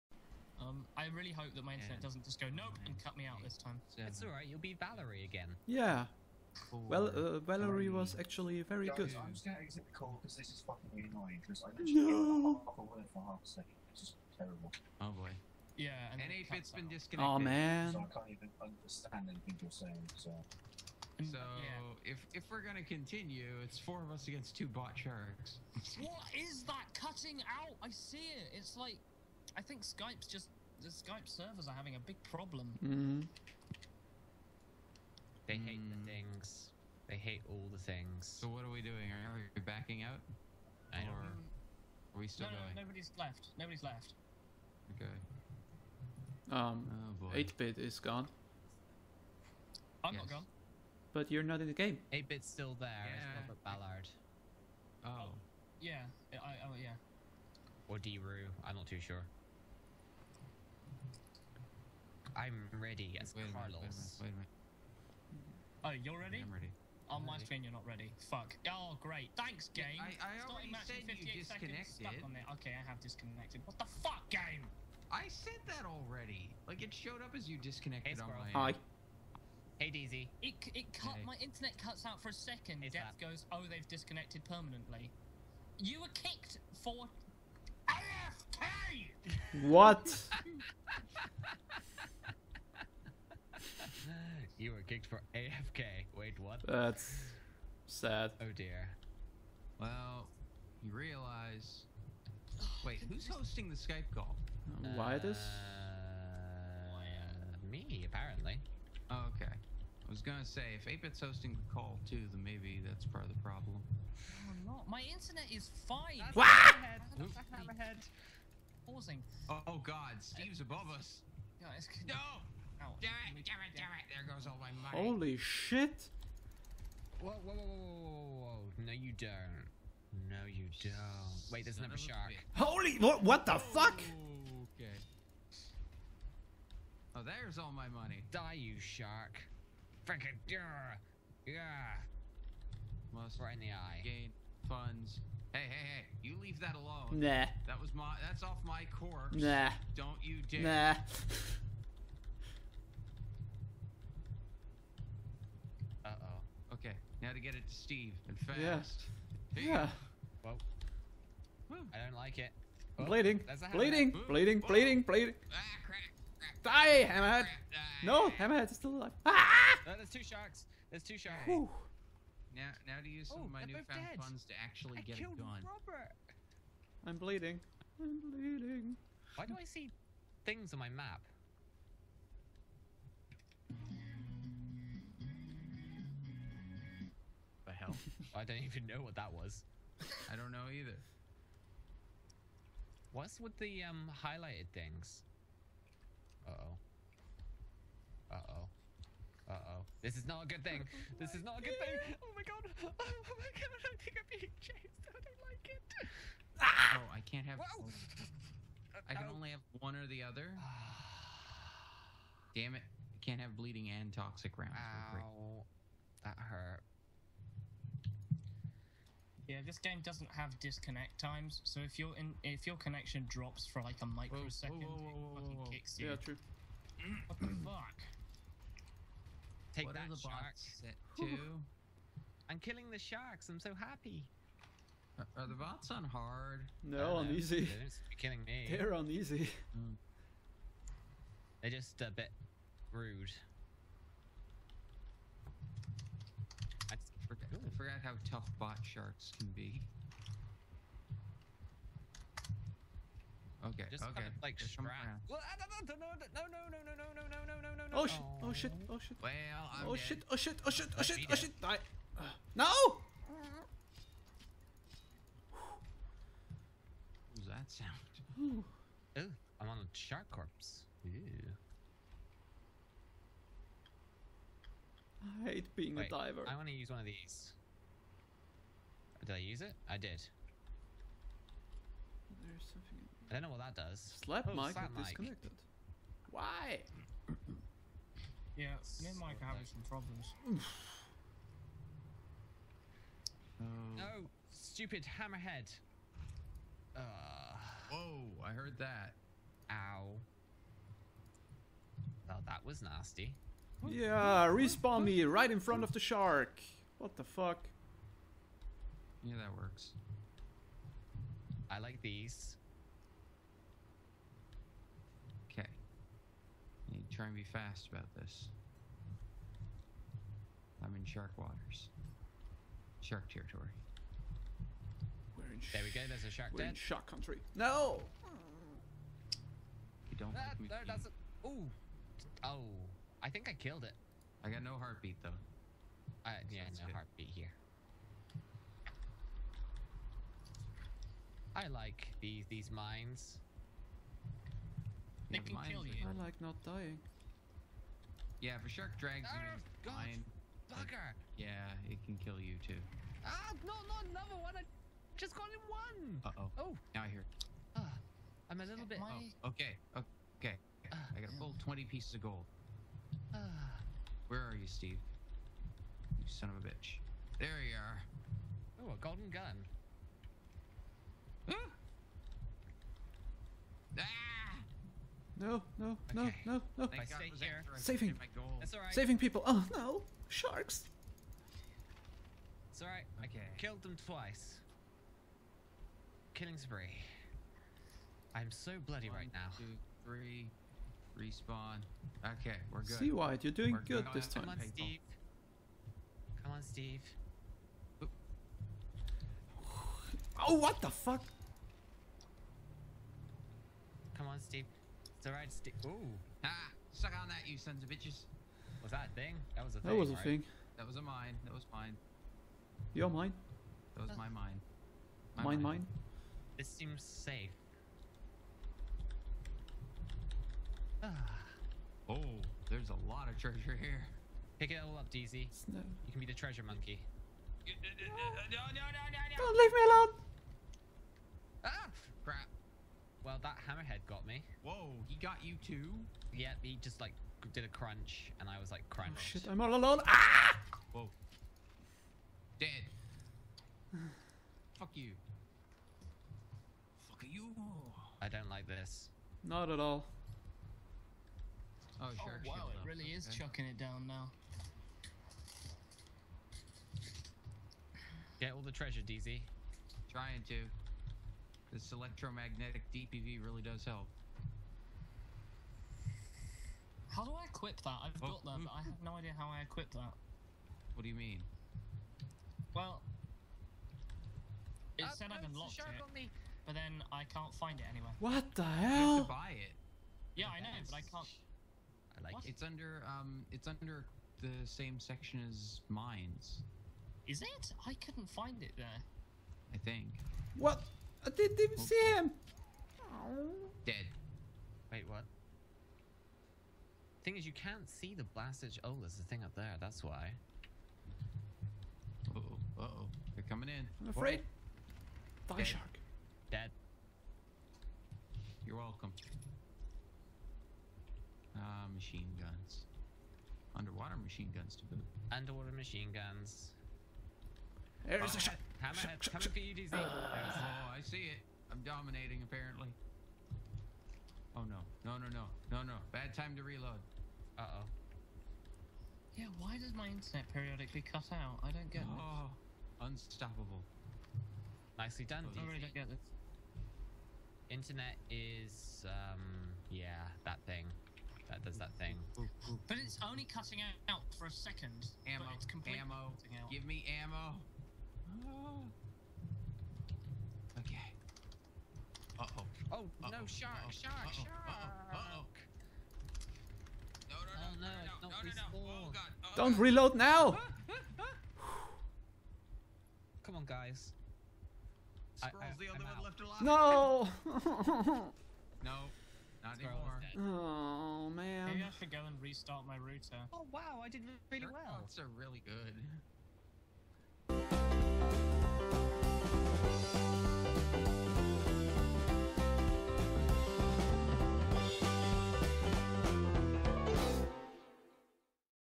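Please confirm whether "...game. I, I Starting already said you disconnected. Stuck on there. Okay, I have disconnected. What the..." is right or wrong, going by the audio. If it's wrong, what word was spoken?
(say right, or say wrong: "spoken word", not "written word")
right.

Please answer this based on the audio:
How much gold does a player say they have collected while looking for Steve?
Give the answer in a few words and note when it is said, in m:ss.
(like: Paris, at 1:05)
20 pieces, at 6:01.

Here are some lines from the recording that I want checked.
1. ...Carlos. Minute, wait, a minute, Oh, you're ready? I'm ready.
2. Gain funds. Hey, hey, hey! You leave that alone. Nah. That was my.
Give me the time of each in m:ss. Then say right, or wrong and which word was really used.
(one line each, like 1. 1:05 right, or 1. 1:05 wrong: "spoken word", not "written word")
1. 1:03 right
2. 2:24 right.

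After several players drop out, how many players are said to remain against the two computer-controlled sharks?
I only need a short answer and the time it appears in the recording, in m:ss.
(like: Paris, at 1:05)
4, at 0:23.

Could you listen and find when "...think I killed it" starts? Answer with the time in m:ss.
5:33.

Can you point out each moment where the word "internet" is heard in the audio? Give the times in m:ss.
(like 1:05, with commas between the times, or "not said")
0:01, 1:21, 1:55, 8:50, 8:57.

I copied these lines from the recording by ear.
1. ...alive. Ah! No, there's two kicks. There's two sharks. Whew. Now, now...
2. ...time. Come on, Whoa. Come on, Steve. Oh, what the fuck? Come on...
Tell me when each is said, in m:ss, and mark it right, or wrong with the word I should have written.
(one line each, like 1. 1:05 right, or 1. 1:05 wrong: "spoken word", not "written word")
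1. 2:48 wrong: "sharks", not "kicks"
2. 6:34 wrong: "Steve", not "Whoa".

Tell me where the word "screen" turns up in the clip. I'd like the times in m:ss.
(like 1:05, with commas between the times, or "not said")
1:07.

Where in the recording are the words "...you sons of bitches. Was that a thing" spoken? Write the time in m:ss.
6:47.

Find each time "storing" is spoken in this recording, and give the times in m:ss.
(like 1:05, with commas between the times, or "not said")
not said.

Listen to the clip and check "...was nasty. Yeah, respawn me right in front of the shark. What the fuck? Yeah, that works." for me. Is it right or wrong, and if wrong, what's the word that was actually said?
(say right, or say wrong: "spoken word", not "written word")
right.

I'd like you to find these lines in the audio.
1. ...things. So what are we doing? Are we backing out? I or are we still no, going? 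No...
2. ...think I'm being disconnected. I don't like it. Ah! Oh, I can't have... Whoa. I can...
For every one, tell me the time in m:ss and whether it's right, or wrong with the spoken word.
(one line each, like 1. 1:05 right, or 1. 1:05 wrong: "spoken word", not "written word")
1. 0:37 right
2. 3:24 wrong: "chased", not "disconnected".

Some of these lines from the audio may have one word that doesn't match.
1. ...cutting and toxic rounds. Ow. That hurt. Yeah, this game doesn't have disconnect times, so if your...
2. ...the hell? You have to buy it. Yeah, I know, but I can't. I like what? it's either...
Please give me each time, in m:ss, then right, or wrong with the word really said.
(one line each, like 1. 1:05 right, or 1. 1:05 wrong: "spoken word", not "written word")
1. 3:33 wrong: "bleeding", not "cutting"
2. 7:58 wrong: "under", not "either".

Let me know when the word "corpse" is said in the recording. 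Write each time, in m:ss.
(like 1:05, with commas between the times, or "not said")
2:28, 4:30.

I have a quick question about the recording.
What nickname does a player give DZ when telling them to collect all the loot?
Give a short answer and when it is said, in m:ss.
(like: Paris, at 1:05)
Treasure monkey, at 7:06.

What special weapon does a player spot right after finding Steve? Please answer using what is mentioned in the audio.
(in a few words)
Golden gun.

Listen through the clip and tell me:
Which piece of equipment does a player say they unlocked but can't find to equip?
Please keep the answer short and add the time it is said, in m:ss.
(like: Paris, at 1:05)
Electromagnetic DPV, at 7:41.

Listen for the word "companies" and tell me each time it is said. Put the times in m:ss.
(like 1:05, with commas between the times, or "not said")
not said.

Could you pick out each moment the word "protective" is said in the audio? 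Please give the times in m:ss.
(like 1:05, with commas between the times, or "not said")
not said.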